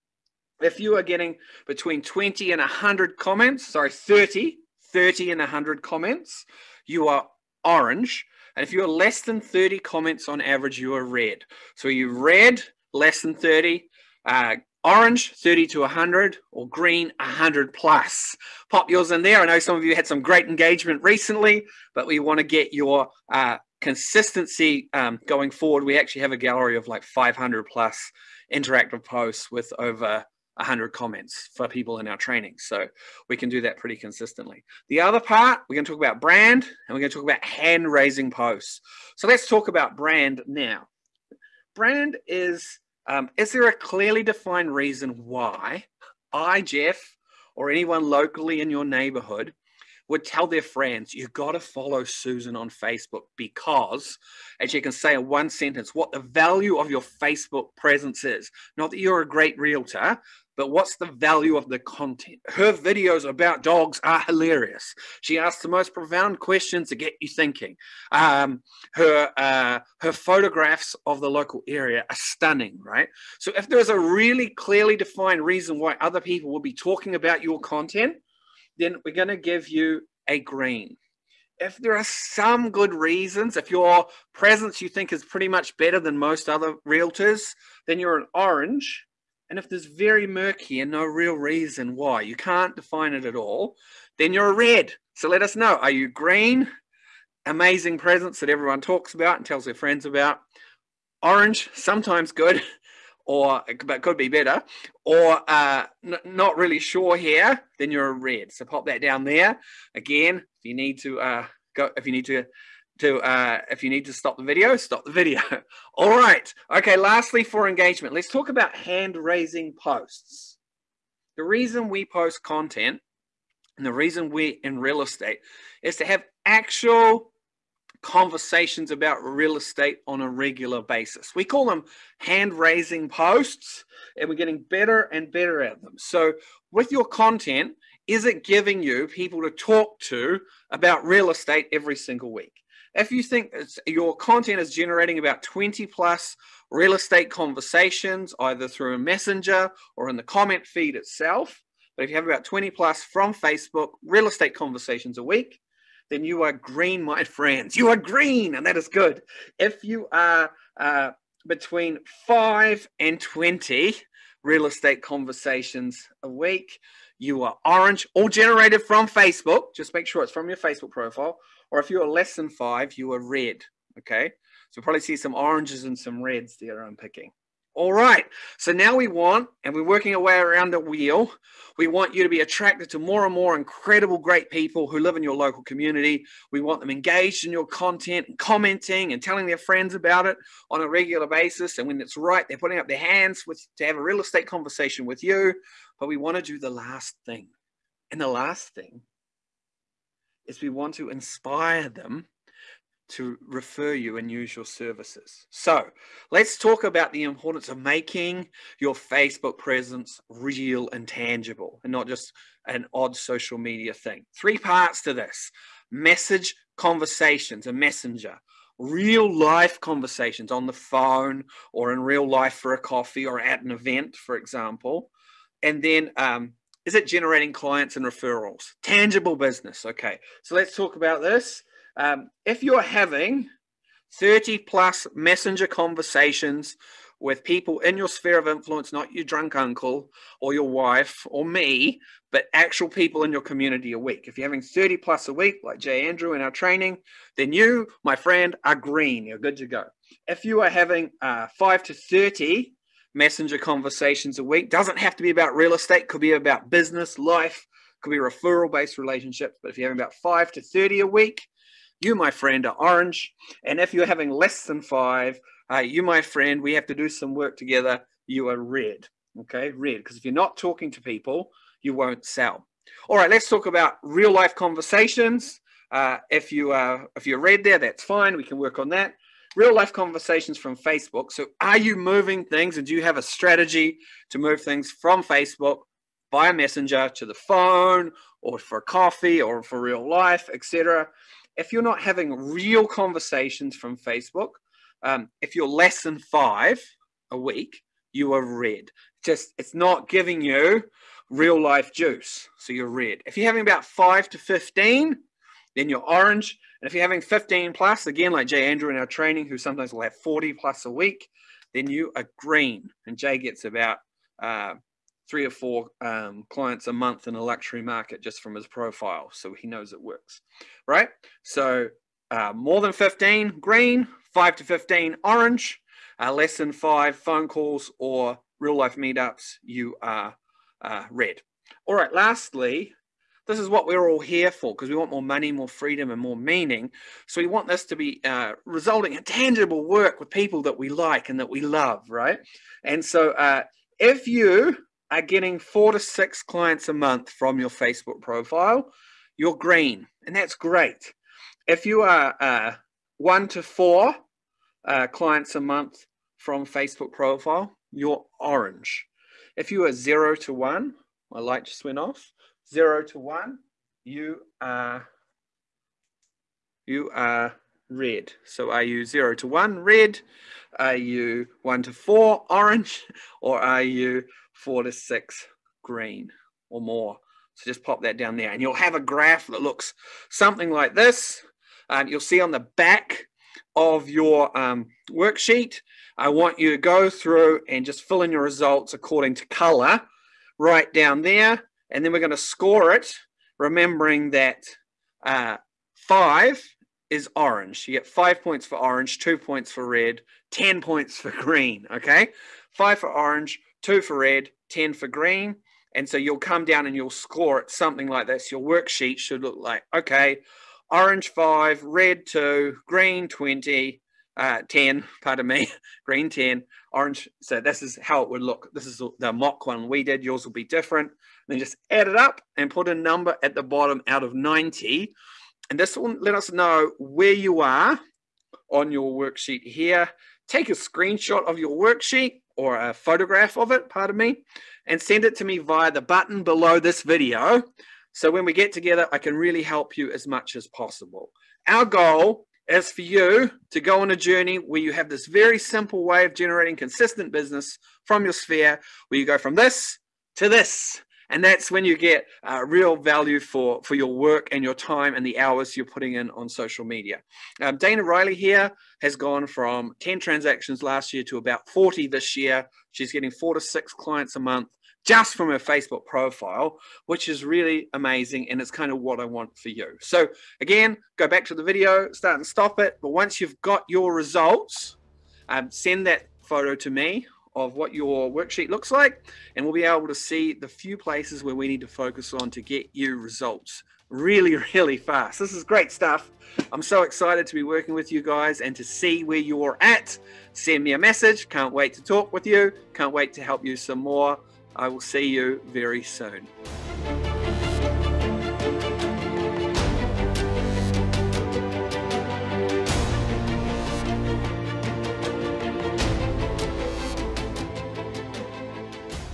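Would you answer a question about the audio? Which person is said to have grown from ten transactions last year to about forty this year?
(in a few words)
Dana Riley.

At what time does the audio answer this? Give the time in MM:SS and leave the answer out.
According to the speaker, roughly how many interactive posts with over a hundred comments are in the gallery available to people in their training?
00:27.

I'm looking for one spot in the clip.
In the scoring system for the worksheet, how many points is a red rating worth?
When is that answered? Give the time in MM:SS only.
06:39.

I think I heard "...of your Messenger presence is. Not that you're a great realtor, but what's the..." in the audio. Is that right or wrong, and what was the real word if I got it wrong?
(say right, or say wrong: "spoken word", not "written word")
wrong: "Facebook", not "Messenger".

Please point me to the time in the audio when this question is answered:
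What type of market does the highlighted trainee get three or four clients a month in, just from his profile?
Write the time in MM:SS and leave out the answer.
05:17.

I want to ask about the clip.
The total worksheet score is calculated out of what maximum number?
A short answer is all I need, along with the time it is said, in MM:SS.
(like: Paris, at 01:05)
90, at 07:04.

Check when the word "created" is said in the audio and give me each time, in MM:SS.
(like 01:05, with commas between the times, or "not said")
not said.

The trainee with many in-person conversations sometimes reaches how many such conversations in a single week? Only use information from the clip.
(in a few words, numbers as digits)
40 plus.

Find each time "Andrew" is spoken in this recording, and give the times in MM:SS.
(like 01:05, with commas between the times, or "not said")
04:06, 05:08.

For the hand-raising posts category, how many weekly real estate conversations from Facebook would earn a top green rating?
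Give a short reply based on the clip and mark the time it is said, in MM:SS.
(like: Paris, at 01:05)
20 plus, at 02:25.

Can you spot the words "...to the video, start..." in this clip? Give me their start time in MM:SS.
07:51.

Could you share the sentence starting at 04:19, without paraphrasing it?
But if you're having about five to 30 a week, you, my friend, are orange.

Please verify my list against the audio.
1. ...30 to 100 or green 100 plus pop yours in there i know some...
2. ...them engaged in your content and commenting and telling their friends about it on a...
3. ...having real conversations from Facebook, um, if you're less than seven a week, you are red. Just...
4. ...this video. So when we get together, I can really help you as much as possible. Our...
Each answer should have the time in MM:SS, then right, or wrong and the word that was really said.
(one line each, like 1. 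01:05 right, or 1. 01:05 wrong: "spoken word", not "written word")
1. 00:15 right
2. 03:06 right
3. 04:52 wrong: "five", not "seven"
4. 07:16 right.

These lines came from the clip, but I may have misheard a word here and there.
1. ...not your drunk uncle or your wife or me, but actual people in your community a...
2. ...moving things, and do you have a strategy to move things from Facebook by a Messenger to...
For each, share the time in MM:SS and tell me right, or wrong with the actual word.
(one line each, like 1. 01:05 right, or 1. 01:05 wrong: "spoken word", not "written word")
1. 03:58 right
2. 04:41 right.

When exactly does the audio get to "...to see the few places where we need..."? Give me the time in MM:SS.
08:00.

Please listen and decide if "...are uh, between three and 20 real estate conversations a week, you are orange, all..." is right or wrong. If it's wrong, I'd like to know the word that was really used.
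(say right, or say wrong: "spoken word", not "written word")
wrong: "five", not "three".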